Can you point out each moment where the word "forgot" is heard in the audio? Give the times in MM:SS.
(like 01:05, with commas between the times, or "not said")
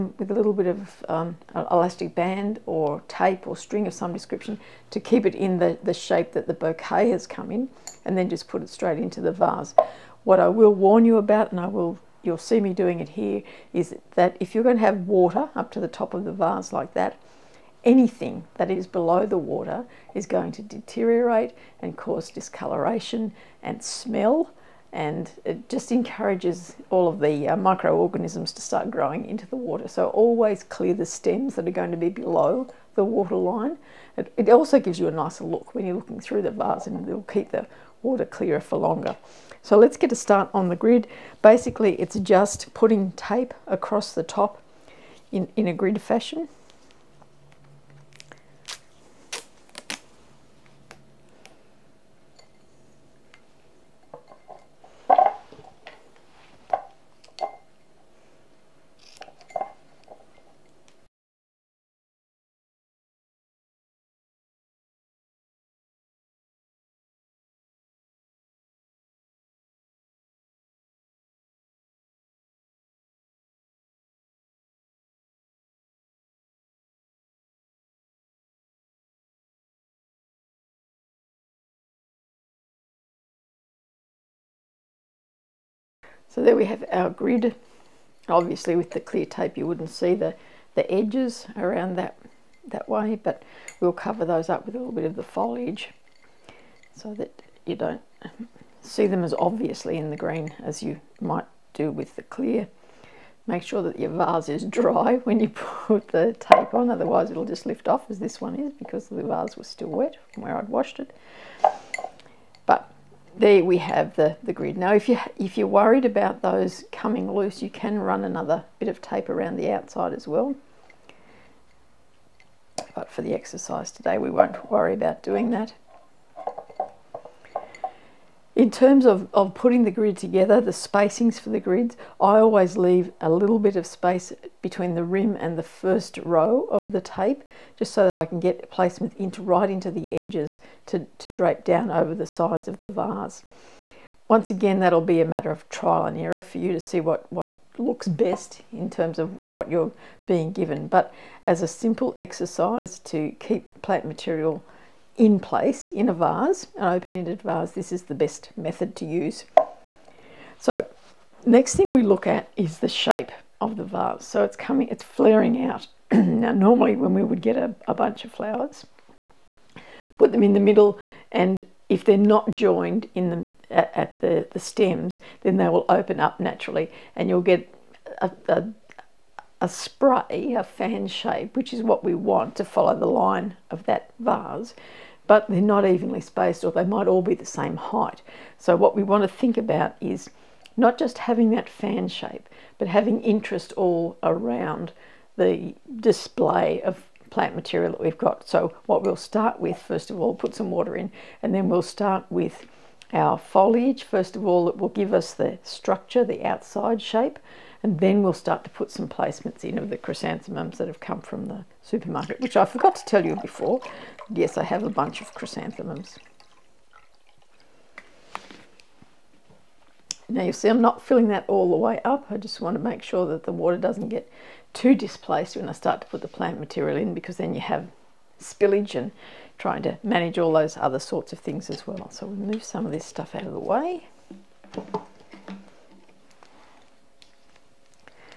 03:32.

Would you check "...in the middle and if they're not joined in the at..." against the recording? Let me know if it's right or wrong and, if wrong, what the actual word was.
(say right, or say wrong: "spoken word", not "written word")
right.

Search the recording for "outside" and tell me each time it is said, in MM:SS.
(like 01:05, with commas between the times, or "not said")
01:59, 03:26.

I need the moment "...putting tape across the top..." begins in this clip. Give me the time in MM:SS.
00:42.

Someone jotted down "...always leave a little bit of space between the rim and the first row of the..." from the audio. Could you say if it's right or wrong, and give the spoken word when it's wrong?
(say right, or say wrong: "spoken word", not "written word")
right.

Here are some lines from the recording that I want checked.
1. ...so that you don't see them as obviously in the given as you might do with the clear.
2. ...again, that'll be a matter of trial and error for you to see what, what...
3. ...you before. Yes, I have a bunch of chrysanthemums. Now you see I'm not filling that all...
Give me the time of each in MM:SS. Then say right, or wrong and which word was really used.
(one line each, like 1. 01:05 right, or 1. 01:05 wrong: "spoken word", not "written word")
1. 01:36 wrong: "green", not "given"
2. 02:24 right
3. 03:33 right.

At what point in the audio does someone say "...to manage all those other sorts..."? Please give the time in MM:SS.
03:49.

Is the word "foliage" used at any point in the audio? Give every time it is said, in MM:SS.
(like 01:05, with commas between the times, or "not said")
01:35, 03:23.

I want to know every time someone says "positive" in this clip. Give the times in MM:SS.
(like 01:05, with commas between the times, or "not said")
not said.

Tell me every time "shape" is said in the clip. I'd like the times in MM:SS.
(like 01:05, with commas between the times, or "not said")
00:05, 02:42, 03:01, 03:12, 03:26.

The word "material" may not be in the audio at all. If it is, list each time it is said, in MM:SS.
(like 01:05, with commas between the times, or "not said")
02:34, 03:17, 03:46.